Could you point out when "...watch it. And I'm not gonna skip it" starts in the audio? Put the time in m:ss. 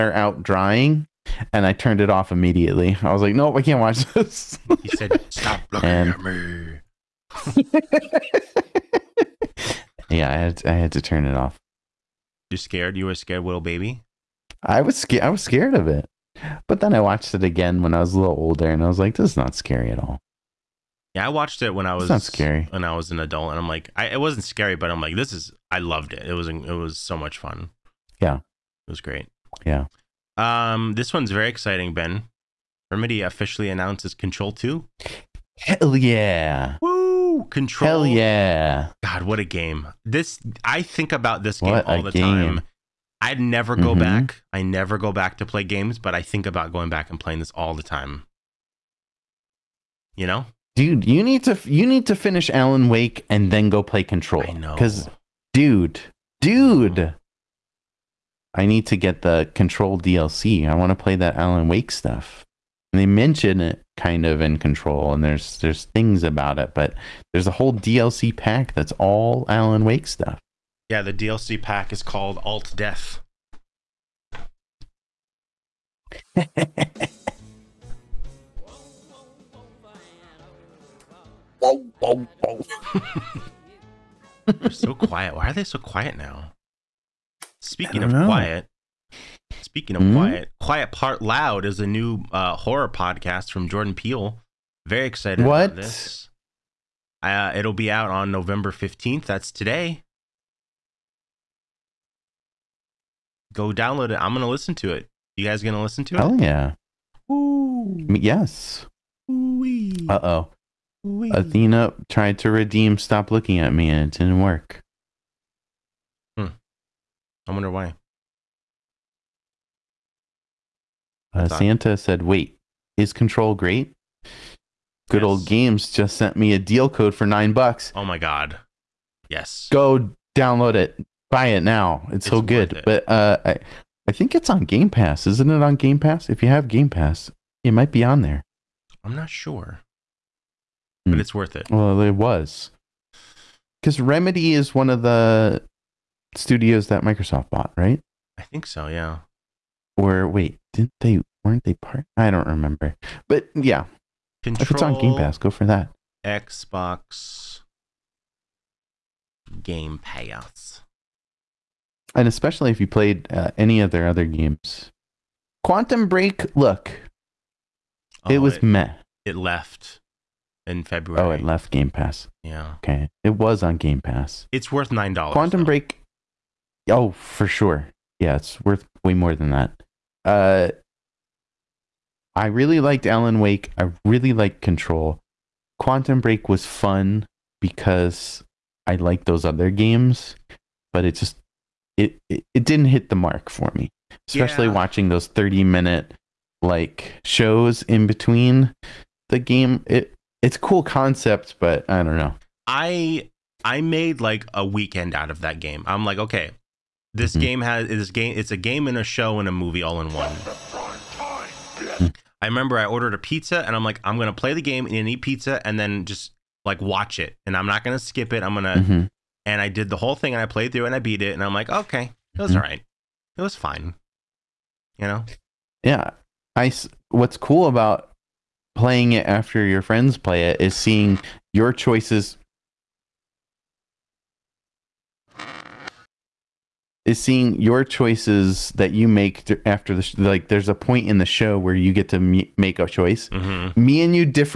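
3:36.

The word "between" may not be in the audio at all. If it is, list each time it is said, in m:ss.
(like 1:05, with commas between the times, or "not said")
3:18.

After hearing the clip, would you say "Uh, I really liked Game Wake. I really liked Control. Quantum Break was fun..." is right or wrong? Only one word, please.
wrong.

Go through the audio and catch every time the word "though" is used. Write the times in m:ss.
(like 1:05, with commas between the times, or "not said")
2:55.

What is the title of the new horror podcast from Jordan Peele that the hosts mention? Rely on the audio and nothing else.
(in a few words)
Quiet Part Loud.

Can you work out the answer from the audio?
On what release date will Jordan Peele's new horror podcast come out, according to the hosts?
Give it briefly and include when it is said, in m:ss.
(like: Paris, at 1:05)
November 15th, at 1:38.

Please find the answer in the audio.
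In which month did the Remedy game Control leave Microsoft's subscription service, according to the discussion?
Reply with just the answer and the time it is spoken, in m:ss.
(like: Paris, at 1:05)
February, at 2:50.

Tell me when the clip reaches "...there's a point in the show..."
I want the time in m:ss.
4:00.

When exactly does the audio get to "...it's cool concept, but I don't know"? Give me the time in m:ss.
3:20.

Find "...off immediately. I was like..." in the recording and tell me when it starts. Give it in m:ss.
0:02.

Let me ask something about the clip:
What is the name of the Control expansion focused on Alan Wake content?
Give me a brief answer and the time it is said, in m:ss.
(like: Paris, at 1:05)
Alt Death, at 1:12.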